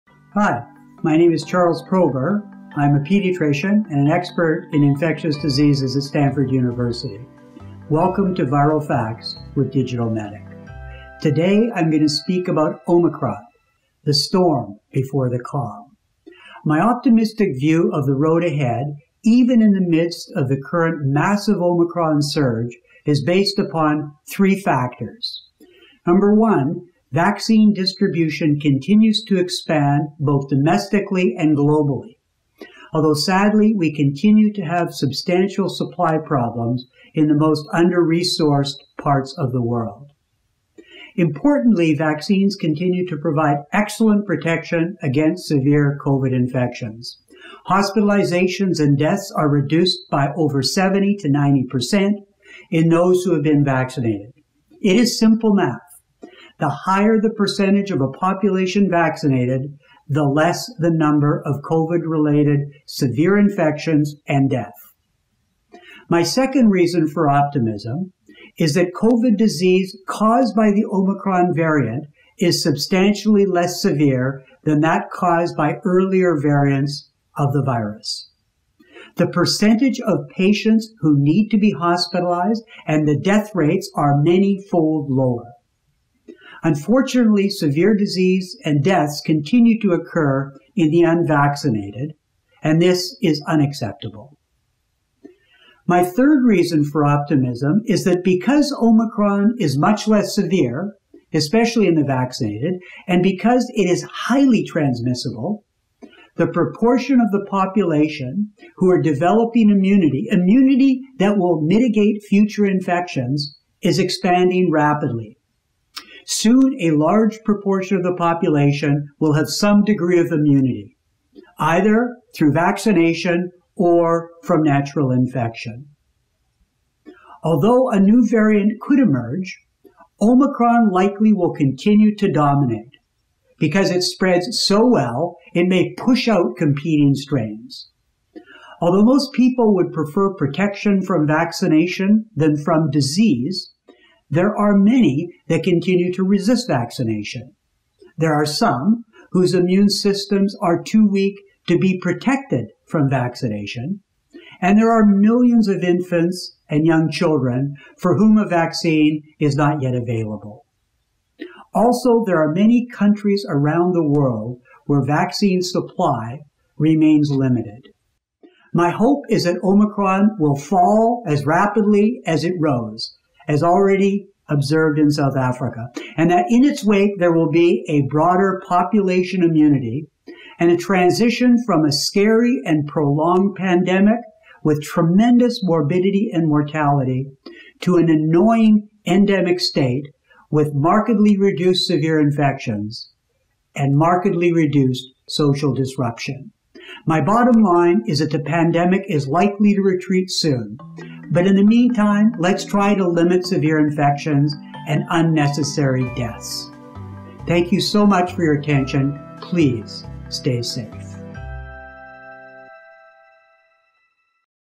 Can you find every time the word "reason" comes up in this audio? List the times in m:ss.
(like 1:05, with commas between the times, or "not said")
1:06, 1:36.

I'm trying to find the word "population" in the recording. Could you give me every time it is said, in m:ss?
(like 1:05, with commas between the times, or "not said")
0:58, 1:47, 1:58, 2:58.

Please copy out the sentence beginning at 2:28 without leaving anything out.
There are some whose immune systems are too weak to be protected from vaccination.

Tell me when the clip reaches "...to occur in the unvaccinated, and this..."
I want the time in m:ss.
1:29.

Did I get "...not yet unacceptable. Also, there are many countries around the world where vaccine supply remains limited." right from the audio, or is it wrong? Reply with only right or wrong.
wrong.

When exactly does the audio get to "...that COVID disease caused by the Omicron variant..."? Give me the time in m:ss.
1:08.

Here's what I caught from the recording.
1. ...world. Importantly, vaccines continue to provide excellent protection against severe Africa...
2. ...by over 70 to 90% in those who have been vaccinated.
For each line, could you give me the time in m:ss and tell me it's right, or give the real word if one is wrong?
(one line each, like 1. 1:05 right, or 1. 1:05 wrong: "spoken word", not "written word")
1. 0:39 wrong: "COVID", not "Africa"
2. 0:50 right.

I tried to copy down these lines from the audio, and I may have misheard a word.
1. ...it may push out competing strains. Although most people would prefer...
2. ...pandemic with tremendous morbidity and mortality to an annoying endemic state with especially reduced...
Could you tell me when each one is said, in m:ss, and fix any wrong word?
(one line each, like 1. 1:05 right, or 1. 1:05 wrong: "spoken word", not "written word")
1. 2:15 right
2. 3:03 wrong: "markedly", not "especially".